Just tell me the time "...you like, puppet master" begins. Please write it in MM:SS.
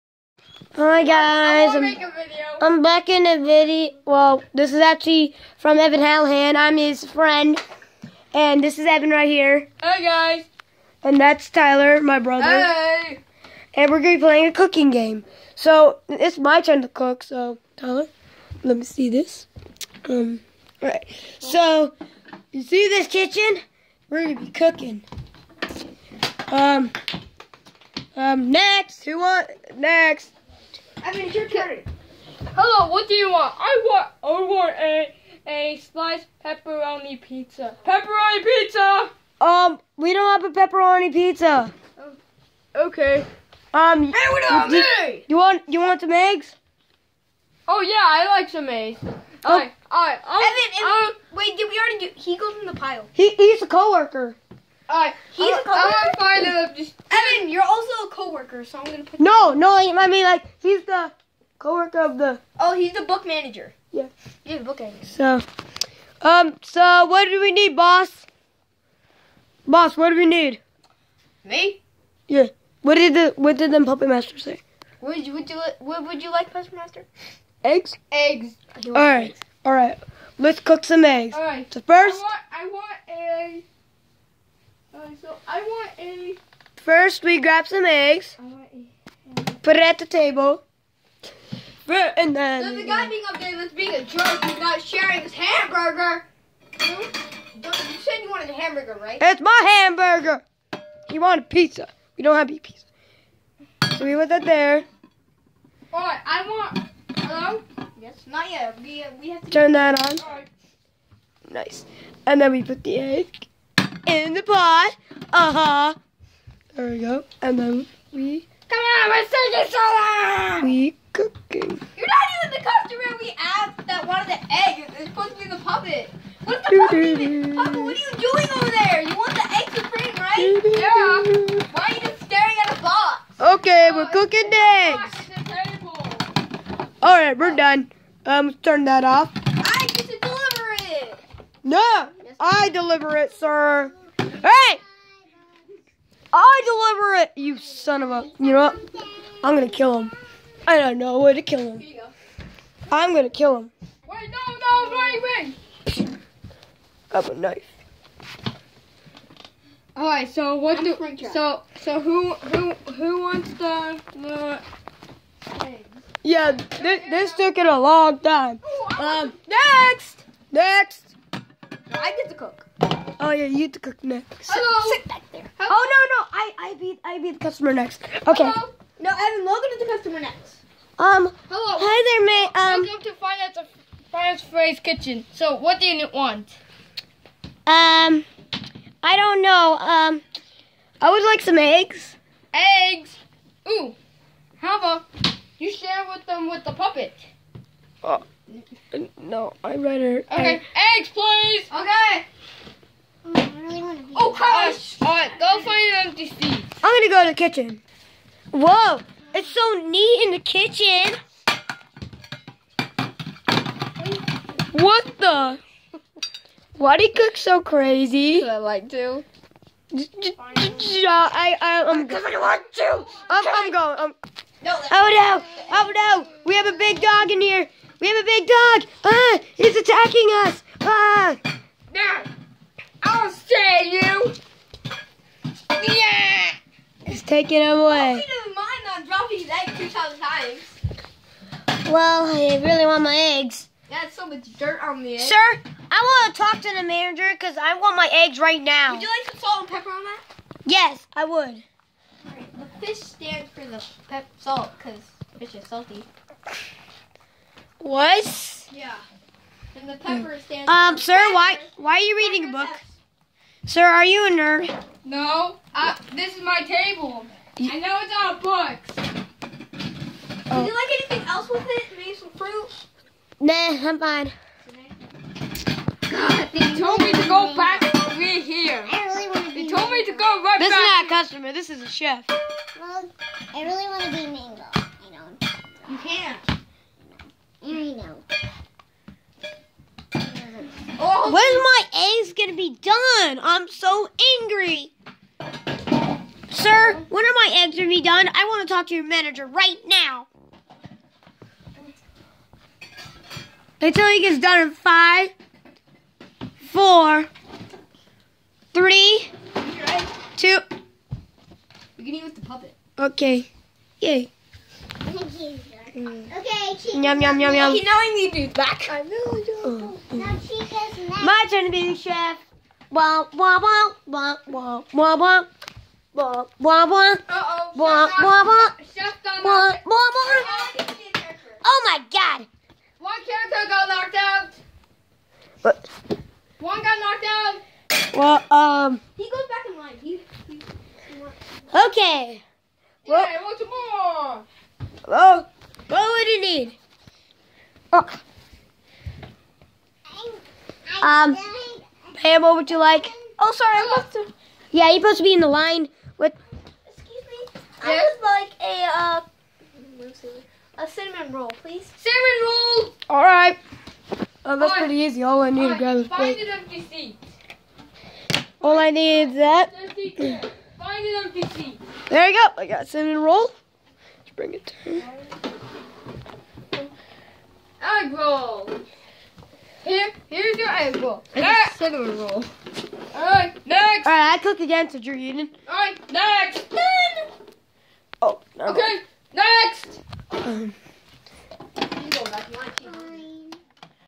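01:16.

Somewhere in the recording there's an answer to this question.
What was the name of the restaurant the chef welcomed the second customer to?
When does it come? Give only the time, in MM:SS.
03:04.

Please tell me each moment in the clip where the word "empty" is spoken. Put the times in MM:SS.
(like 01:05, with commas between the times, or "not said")
03:26, 06:06, 06:11.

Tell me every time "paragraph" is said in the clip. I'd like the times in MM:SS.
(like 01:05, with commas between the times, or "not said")
not said.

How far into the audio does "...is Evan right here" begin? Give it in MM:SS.
00:08.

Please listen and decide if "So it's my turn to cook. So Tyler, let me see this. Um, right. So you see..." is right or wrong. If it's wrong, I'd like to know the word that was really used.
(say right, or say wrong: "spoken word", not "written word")
right.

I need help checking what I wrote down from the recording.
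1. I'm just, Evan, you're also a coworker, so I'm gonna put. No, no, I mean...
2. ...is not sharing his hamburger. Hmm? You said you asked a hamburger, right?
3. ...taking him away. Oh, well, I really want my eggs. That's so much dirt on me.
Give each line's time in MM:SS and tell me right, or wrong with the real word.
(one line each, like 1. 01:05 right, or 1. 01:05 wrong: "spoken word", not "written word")
1. 00:56 right
2. 01:34 wrong: "wanted", not "asked"
3. 03:57 right.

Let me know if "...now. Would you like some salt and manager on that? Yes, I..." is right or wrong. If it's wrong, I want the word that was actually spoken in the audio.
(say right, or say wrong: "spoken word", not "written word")
wrong: "pepper", not "manager".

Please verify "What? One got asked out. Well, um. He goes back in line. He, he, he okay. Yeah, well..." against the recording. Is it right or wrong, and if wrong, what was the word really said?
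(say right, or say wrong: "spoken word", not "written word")
wrong: "knocked", not "asked".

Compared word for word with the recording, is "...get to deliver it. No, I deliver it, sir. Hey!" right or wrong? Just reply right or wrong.
right.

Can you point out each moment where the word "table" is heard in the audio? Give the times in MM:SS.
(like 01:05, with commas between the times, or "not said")
01:30, 04:26.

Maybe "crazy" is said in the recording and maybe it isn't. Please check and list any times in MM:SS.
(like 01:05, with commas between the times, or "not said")
03:37.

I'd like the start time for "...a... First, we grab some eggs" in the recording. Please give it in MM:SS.
01:25.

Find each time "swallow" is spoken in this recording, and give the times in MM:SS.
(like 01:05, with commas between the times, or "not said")
not said.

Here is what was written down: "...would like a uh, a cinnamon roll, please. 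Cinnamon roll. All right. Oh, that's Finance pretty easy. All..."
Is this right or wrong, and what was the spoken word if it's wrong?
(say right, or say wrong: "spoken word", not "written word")
wrong: "All", not "Finance".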